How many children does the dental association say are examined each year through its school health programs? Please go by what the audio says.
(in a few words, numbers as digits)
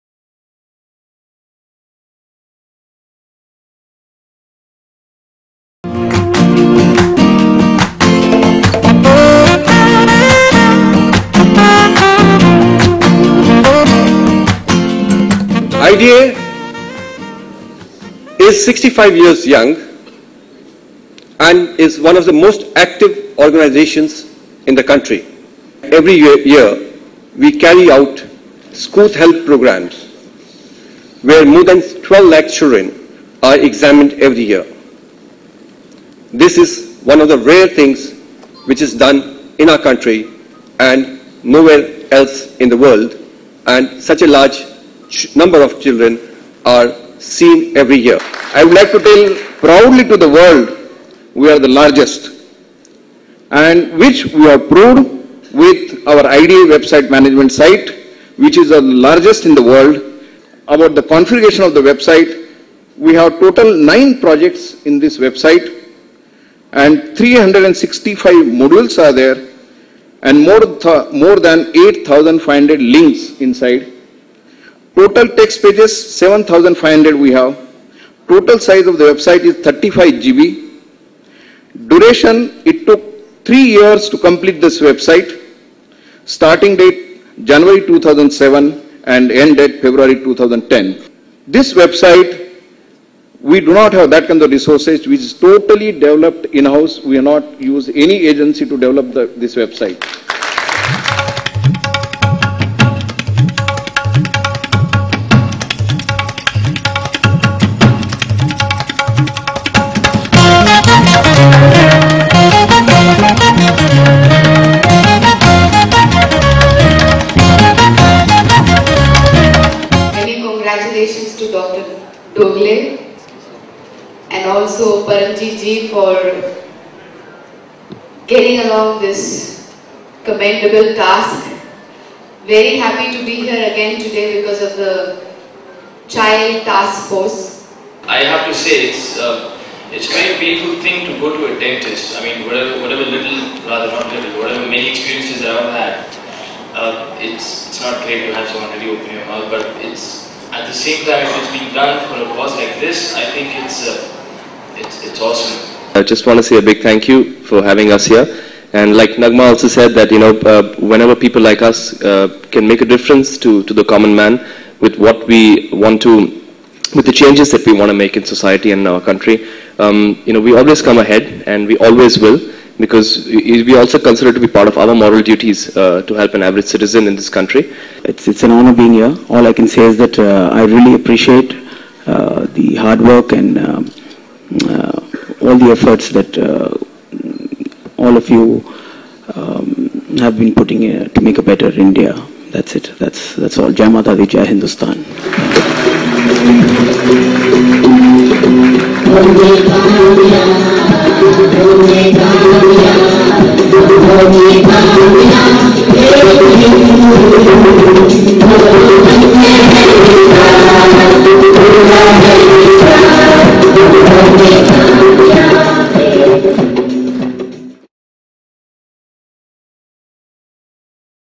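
12 lakh.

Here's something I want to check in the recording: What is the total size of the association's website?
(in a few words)
35 GB.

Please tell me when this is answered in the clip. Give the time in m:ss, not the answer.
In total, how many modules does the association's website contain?
1:07.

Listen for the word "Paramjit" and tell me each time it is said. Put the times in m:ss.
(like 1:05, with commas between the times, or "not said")
2:05.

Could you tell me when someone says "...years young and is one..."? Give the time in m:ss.
0:19.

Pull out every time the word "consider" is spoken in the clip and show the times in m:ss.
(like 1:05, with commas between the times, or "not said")
2:53.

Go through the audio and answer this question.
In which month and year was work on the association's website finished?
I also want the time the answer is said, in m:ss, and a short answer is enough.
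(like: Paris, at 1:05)
February 2010, at 1:29.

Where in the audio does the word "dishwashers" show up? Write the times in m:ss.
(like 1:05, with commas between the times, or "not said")
not said.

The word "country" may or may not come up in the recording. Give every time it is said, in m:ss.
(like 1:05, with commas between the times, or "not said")
0:24, 0:39, 2:49, 2:57.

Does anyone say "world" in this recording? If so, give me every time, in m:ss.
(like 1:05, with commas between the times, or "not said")
0:42, 0:50, 0:59.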